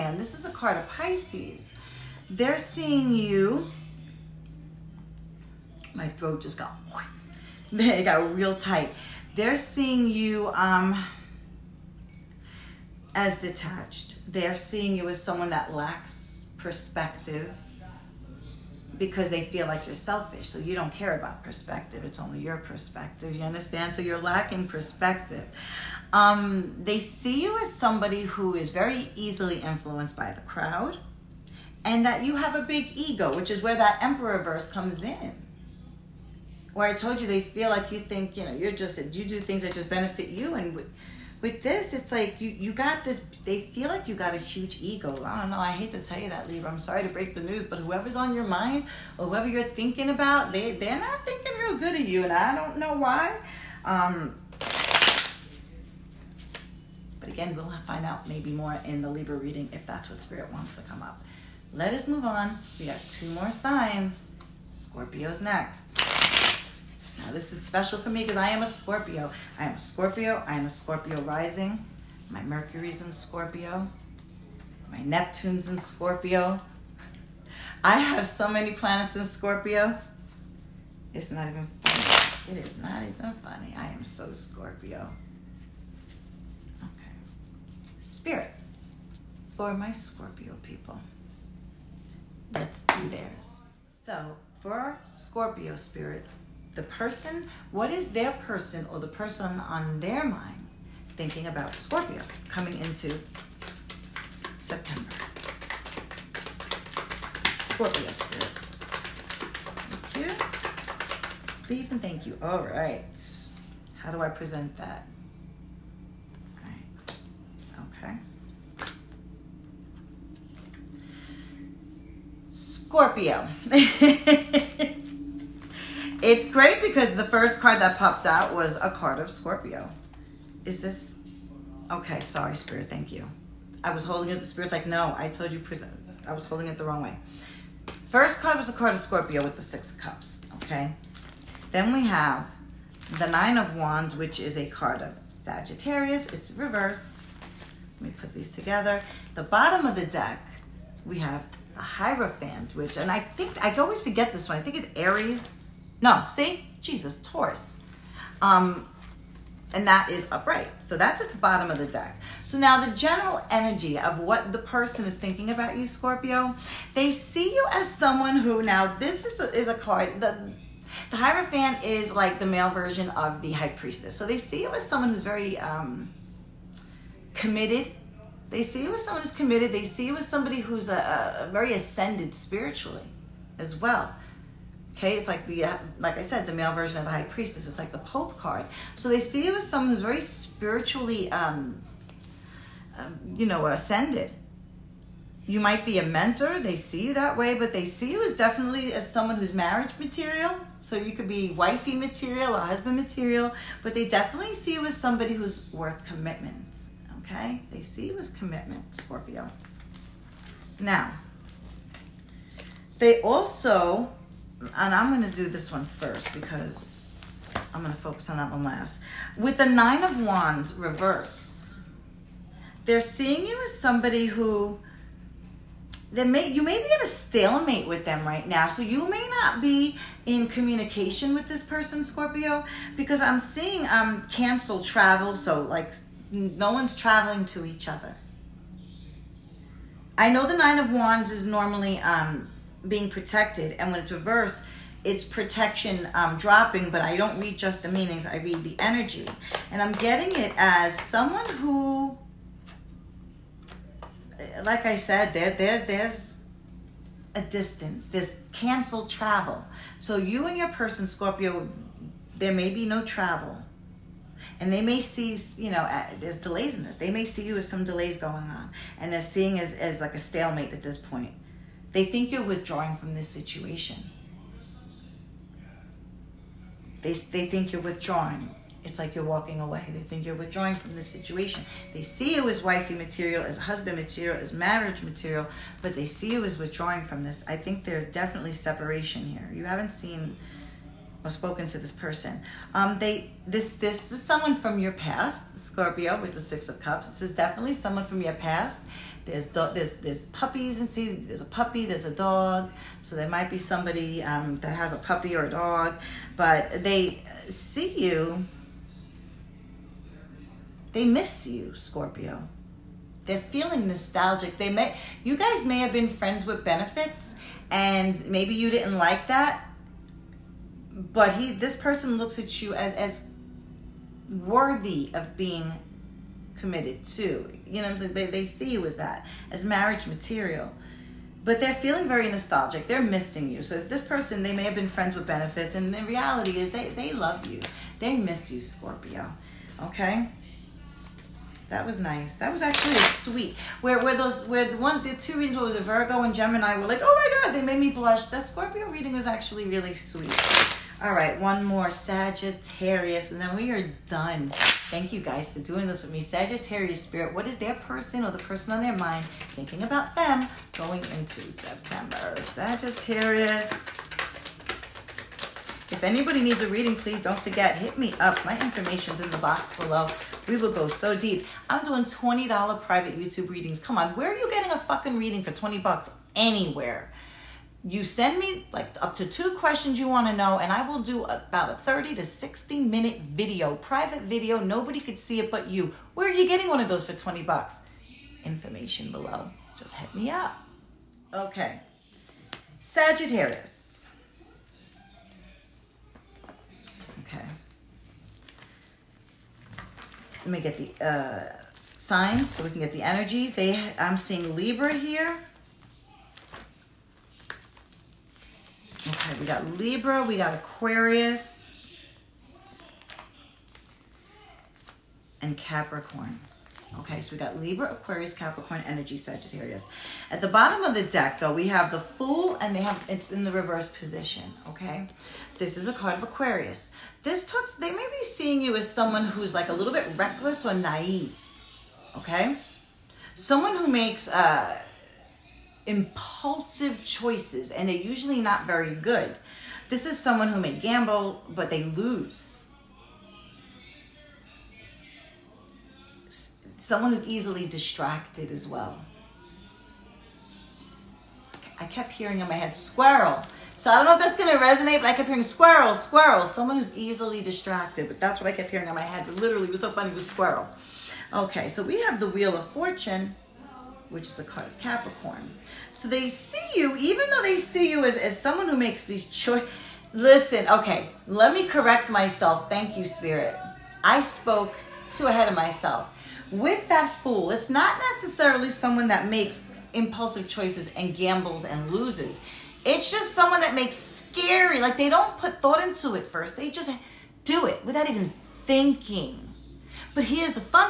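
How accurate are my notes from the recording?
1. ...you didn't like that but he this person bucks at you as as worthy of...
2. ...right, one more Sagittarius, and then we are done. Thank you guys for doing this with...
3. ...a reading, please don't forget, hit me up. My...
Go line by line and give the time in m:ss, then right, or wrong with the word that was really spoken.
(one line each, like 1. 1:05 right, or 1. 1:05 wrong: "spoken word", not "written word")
1. 5:18 wrong: "looks", not "bucks"
2. 5:51 right
3. 6:06 right.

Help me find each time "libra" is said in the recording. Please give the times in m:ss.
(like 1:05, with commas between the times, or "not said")
0:46, 0:59, 6:44, 6:49, 6:57.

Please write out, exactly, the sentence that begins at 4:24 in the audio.
And they may see, you know, uh, there's delays in this.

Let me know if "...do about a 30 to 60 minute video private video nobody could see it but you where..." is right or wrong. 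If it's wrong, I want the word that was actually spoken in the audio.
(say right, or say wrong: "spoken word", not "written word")
right.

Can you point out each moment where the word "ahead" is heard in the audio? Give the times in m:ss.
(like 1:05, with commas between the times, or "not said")
7:55.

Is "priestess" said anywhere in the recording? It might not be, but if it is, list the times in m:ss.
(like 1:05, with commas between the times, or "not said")
2:53, 3:07.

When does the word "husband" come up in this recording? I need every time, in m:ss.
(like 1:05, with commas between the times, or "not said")
3:22, 4:43.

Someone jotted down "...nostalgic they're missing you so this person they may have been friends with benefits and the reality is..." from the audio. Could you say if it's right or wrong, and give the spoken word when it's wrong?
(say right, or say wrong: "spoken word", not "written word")
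right.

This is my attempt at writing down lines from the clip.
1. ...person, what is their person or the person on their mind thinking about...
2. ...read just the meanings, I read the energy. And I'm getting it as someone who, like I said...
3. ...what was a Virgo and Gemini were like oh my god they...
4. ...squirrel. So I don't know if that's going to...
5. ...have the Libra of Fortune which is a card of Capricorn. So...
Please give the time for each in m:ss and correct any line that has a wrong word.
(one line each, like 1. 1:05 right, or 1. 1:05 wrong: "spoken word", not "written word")
1. 1:36 right
2. 4:07 right
3. 5:45 right
4. 7:32 right
5. 7:42 wrong: "Wheel", not "Libra".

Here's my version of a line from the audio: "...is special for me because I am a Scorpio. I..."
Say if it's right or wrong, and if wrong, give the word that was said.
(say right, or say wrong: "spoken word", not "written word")
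right.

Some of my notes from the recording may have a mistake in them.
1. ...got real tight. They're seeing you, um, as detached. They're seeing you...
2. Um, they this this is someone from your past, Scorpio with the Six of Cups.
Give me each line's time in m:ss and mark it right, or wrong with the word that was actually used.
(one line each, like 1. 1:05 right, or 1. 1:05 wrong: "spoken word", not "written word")
1. 0:08 right
2. 4:52 right.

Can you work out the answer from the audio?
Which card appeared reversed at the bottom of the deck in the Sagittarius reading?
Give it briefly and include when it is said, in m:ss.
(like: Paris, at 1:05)
The Fool, at 7:01.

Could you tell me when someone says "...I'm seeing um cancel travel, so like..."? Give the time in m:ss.
3:53.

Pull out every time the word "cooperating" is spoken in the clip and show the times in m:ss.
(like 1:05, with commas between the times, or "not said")
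not said.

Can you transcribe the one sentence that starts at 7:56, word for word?
With that fool, it's not necessarily someone that makes impulsive choices and gambles and loses.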